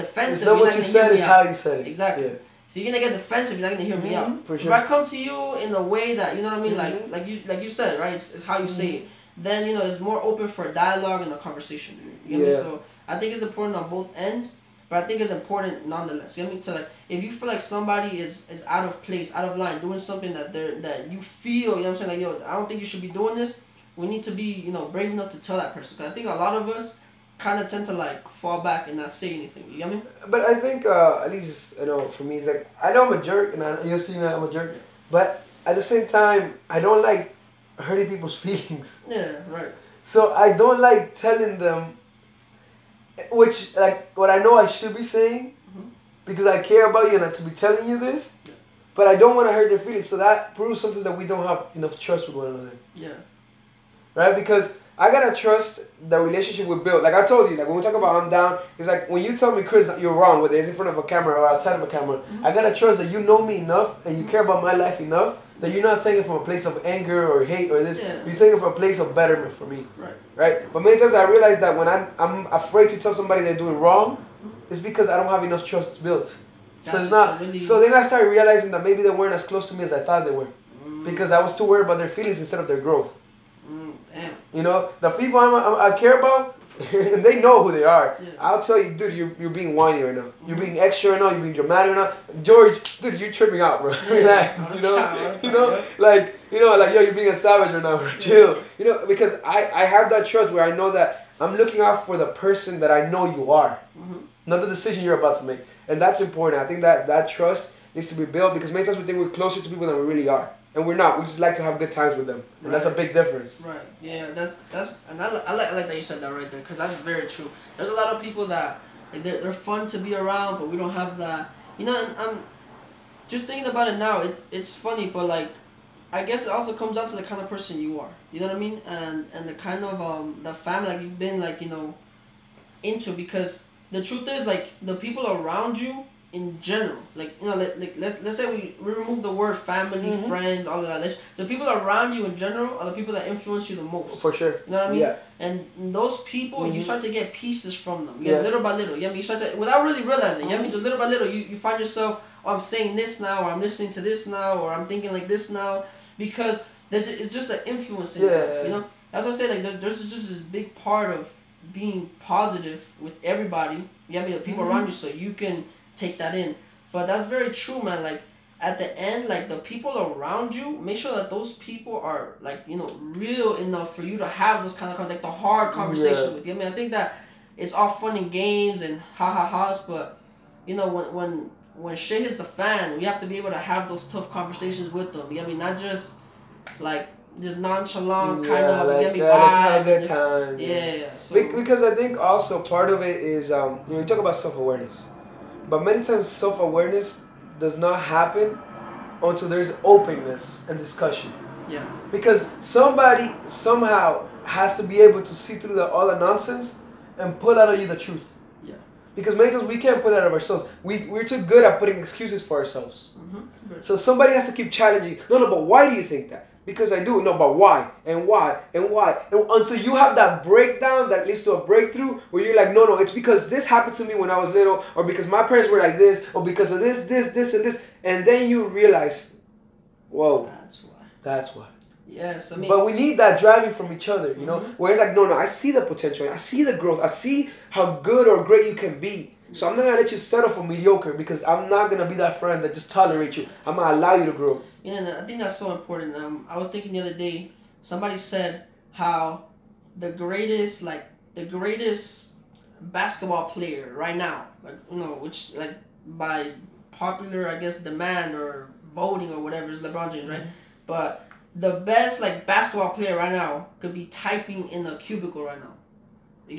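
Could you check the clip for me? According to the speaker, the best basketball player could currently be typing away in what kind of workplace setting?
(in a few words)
a cubicle.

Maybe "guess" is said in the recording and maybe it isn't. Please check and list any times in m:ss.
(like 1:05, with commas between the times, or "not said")
2:06, 4:17.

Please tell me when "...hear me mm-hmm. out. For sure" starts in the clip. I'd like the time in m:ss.
0:03.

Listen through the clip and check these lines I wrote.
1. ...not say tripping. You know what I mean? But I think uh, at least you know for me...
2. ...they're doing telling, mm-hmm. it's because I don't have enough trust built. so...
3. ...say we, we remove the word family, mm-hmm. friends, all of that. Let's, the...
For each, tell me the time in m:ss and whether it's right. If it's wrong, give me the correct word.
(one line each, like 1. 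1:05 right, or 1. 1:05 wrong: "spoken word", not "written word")
1. 0:28 wrong: "anything", not "tripping"
2. 1:13 wrong: "wrong", not "telling"
3. 2:18 right.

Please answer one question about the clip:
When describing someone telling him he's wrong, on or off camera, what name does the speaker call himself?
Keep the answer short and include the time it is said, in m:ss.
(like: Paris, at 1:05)
Chris, at 0:59.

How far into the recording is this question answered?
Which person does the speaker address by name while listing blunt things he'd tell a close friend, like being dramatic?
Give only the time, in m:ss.
1:32.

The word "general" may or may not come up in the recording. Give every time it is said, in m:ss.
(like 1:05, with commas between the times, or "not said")
2:16, 2:22.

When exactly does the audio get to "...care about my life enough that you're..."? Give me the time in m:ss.
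1:04.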